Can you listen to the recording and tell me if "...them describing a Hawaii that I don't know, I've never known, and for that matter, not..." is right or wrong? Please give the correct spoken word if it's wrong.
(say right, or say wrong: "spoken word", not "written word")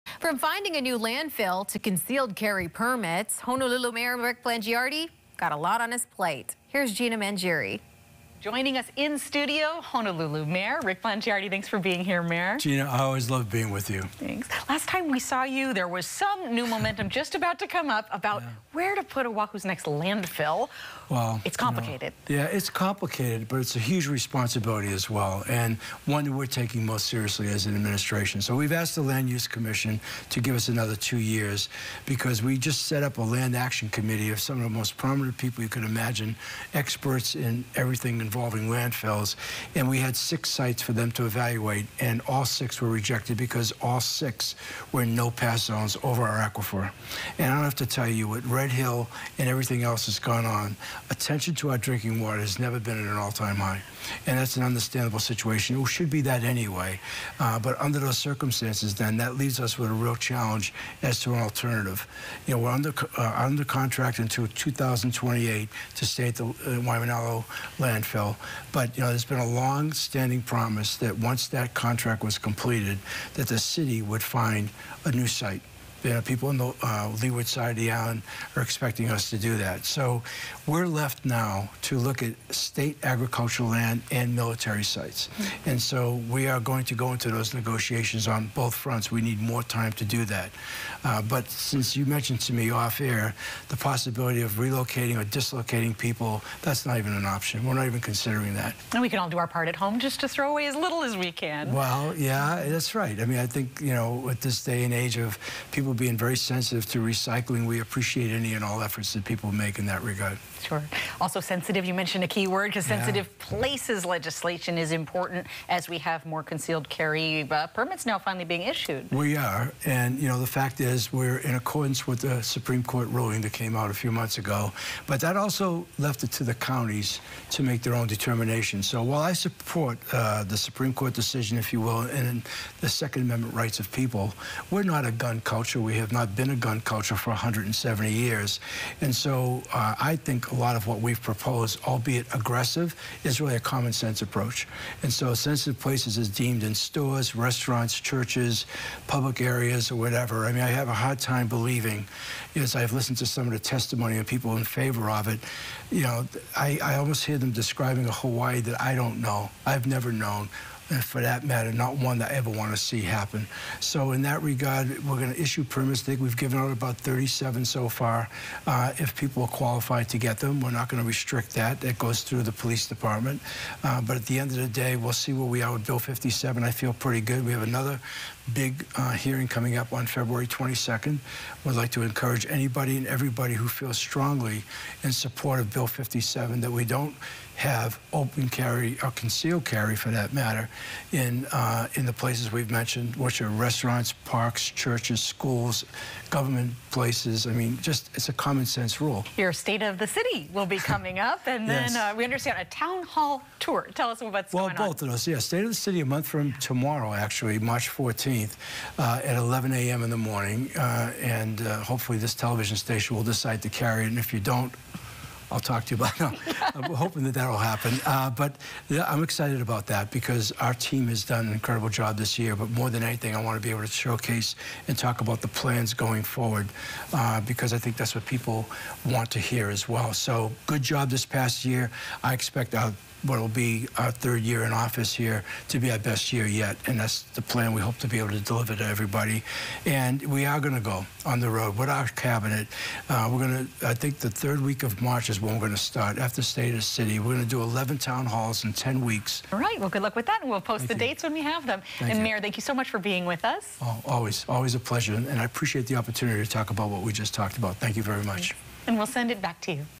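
right.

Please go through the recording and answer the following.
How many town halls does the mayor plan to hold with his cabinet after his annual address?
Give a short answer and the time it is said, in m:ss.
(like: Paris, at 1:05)
11, at 4:07.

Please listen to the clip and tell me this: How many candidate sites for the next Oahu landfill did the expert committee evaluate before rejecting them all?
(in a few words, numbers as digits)
6.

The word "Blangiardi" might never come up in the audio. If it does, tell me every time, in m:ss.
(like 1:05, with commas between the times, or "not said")
0:04, 0:11.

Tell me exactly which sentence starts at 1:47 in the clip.
We appreciate any and all efforts that people make in that regard.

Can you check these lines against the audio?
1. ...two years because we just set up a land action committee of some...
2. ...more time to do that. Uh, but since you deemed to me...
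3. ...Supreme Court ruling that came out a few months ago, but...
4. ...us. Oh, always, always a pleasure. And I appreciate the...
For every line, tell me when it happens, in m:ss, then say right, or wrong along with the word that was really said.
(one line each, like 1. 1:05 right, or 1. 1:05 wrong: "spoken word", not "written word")
1. 0:30 right
2. 1:29 wrong: "mentioned", not "deemed"
3. 2:02 right
4. 4:13 right.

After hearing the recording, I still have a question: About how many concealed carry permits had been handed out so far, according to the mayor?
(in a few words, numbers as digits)
37.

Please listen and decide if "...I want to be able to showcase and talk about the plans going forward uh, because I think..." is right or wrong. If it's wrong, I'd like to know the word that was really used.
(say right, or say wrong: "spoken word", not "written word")
right.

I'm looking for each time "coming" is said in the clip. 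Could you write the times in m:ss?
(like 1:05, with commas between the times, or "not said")
2:59, 3:20.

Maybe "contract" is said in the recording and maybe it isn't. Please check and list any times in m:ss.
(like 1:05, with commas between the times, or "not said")
1:03, 1:11.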